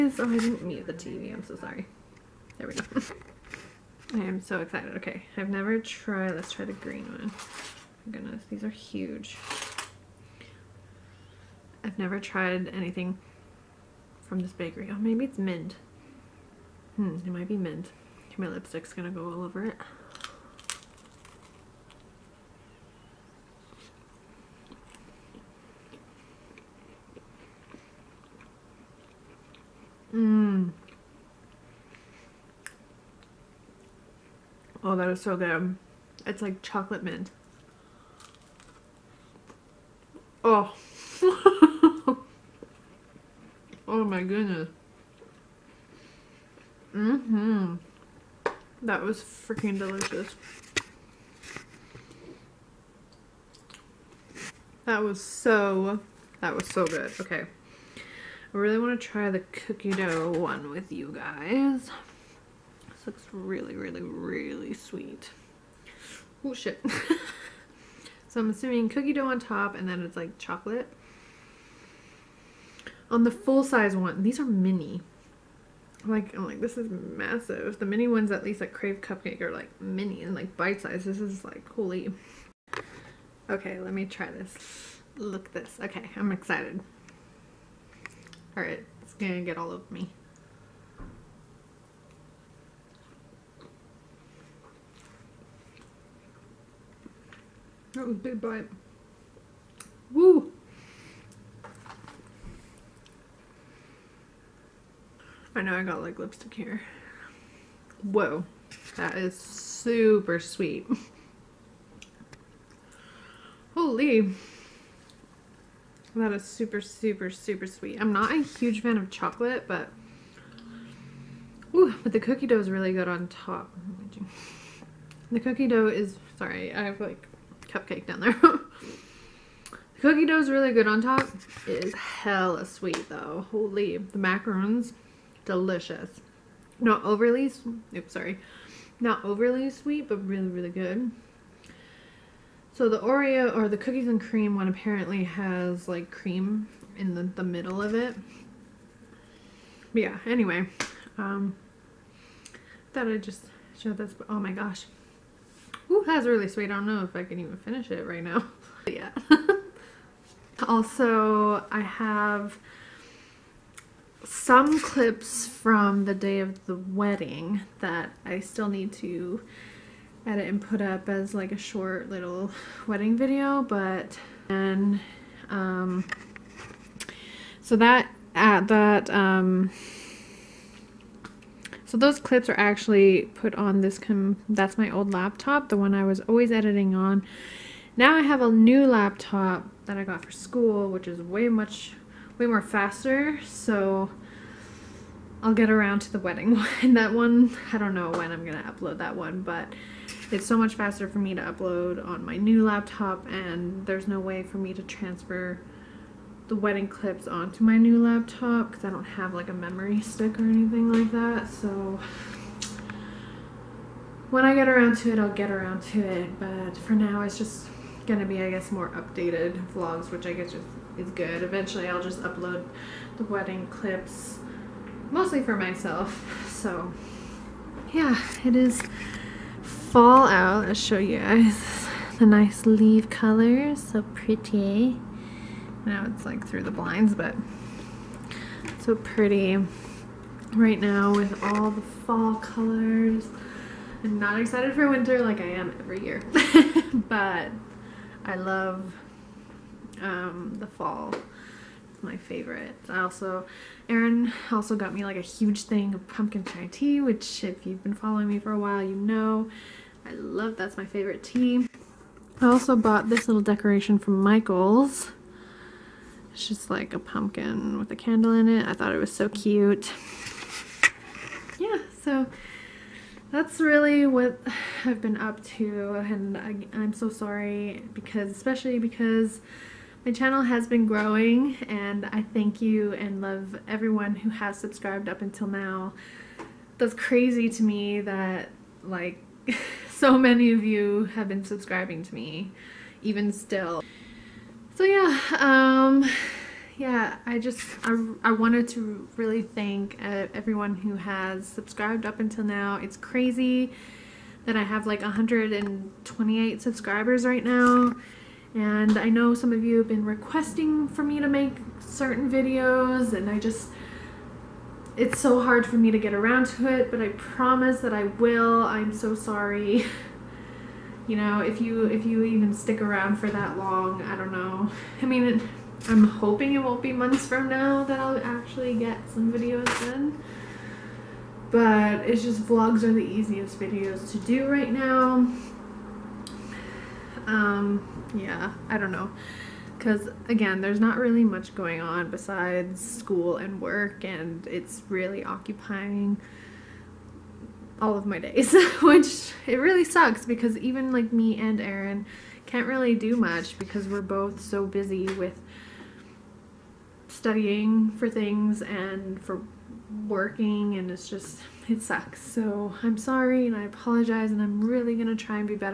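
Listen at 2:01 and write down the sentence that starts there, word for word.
Ooh, but the cookie dough is really good on top.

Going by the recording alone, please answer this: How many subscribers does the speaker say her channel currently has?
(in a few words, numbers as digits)
128.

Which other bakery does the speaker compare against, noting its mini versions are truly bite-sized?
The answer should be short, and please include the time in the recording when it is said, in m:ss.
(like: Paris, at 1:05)
Crave Cupcake, at 1:18.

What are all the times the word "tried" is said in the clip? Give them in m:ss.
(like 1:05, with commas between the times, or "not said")
0:05, 0:12.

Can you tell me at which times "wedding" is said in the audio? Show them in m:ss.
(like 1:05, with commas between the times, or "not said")
2:46, 2:52, 3:16, 3:26, 3:43.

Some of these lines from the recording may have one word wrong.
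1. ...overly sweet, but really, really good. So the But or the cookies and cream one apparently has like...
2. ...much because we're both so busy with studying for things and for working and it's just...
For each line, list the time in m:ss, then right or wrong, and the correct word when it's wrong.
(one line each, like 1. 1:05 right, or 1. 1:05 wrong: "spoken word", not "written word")
1. 2:19 wrong: "Oreo", not "But"
2. 5:53 right.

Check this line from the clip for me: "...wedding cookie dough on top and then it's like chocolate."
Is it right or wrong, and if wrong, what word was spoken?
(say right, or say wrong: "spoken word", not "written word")
wrong: "assuming", not "wedding".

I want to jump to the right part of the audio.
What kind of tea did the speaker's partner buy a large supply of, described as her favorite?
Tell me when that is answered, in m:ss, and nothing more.
4:16.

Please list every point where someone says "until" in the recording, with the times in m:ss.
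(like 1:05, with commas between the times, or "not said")
4:45, 5:02.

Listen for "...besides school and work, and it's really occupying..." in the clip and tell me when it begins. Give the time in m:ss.
5:42.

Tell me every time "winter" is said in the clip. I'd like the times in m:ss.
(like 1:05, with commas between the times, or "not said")
4:04.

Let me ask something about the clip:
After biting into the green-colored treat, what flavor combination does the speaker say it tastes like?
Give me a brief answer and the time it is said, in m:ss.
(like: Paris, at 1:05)
Chocolate mint, at 0:36.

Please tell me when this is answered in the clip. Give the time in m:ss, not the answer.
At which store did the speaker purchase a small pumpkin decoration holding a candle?
4:24.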